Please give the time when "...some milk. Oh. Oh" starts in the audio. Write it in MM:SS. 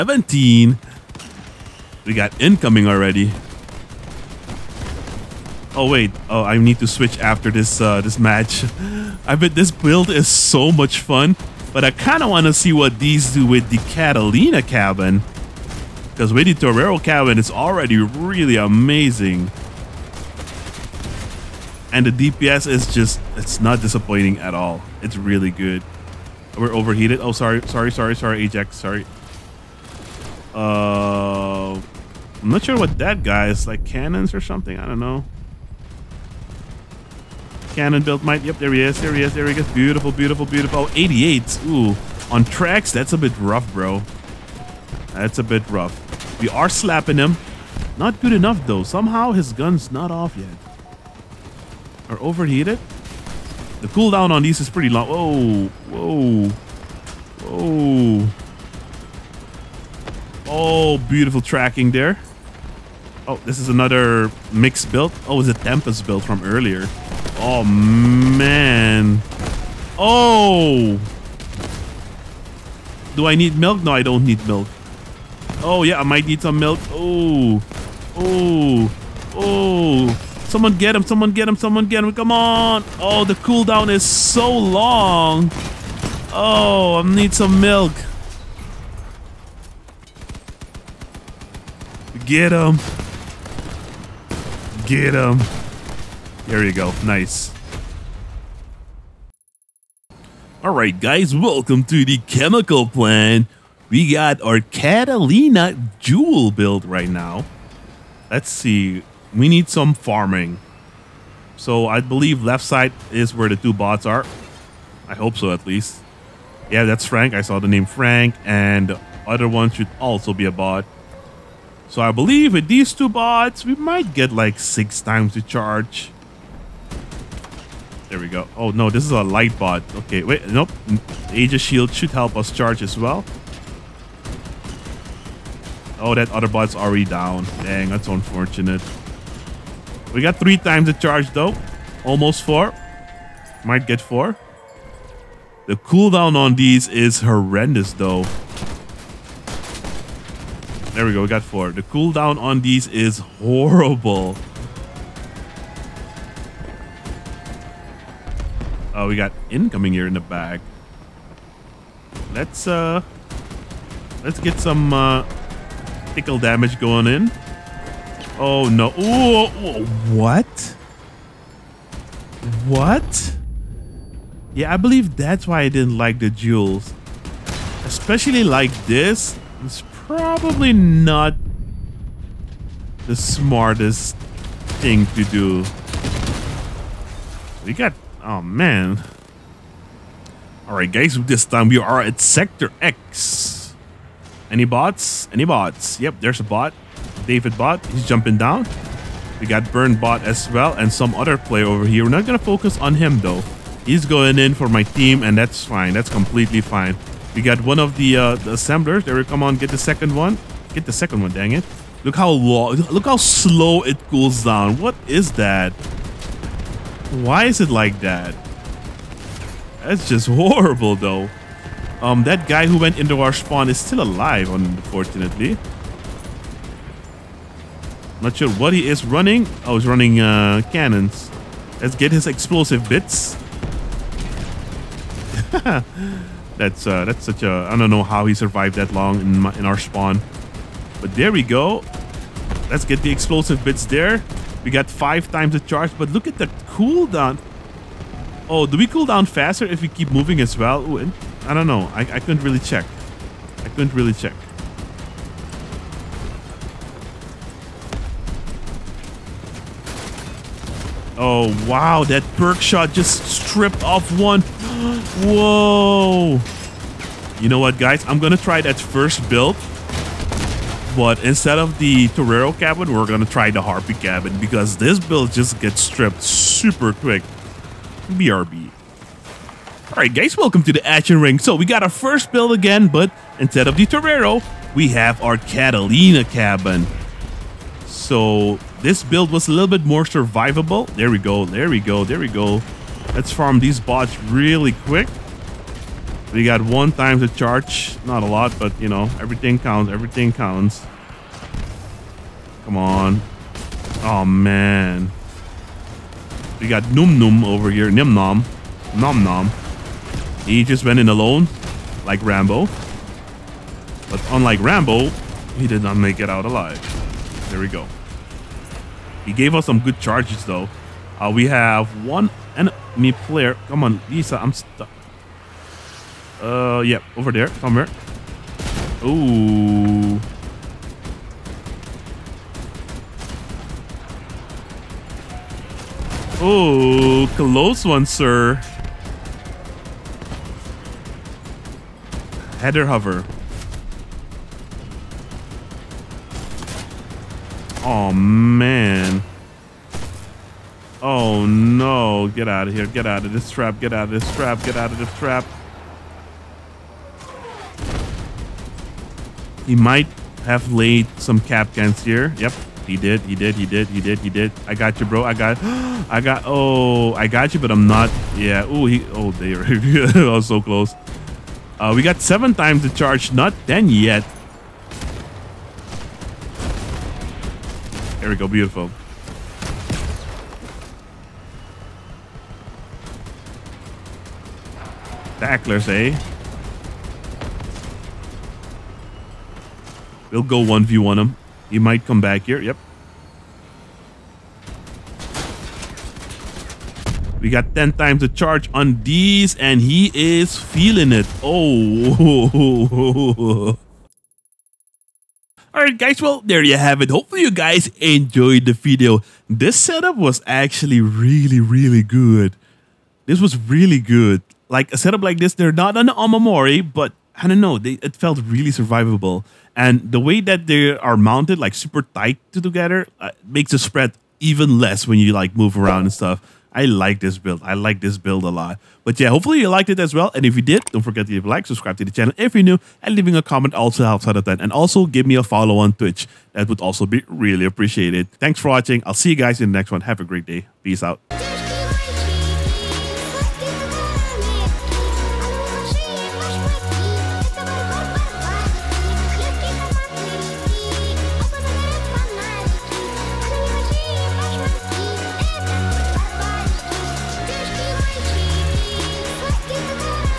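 01:16.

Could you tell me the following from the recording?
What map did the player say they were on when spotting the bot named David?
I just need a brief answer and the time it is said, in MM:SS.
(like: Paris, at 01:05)
Sector EX, at 03:12.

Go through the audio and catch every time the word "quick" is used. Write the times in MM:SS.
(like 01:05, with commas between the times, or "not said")
04:36, 04:54.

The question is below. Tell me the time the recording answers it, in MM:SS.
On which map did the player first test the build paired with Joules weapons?
01:42.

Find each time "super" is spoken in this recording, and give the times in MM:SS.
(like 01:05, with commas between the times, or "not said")
04:36, 07:01.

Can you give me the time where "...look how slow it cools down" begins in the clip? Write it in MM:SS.
03:32.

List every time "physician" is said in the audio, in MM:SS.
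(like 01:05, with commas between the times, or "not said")
not said.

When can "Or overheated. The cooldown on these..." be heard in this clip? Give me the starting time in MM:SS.
00:52.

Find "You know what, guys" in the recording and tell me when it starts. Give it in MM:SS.
04:27.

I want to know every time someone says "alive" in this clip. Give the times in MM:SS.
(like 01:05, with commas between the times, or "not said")
03:44, 05:16.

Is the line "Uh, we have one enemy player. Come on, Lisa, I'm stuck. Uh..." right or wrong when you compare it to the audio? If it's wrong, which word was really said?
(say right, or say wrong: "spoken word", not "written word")
right.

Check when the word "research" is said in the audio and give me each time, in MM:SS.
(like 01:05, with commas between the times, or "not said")
not said.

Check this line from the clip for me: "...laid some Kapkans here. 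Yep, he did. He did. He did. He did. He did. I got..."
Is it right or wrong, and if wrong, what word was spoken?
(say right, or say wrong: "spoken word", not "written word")
right.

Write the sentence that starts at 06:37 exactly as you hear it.
We got 10 times the charge on these, and he is feeling it.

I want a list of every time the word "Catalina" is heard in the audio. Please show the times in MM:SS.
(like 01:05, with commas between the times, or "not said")
00:13, 01:44, 04:45.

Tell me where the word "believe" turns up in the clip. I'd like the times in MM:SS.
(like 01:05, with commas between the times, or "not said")
01:51, 02:02, 02:54.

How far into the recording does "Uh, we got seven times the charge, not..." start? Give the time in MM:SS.
06:11.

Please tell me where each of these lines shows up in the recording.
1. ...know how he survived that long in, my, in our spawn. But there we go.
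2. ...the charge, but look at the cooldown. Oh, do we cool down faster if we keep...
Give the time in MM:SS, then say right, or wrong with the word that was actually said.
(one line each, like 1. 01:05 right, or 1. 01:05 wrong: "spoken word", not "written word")
1. 03:57 right
2. 04:05 right.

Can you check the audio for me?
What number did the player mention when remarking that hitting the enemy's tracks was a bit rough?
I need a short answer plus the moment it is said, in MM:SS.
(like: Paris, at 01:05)
88, at 00:40.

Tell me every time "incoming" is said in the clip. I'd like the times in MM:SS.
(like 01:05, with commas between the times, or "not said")
00:02, 02:39.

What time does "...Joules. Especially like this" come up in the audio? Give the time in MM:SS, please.
02:56.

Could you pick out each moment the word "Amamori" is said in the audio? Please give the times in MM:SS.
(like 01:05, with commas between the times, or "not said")
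06:56.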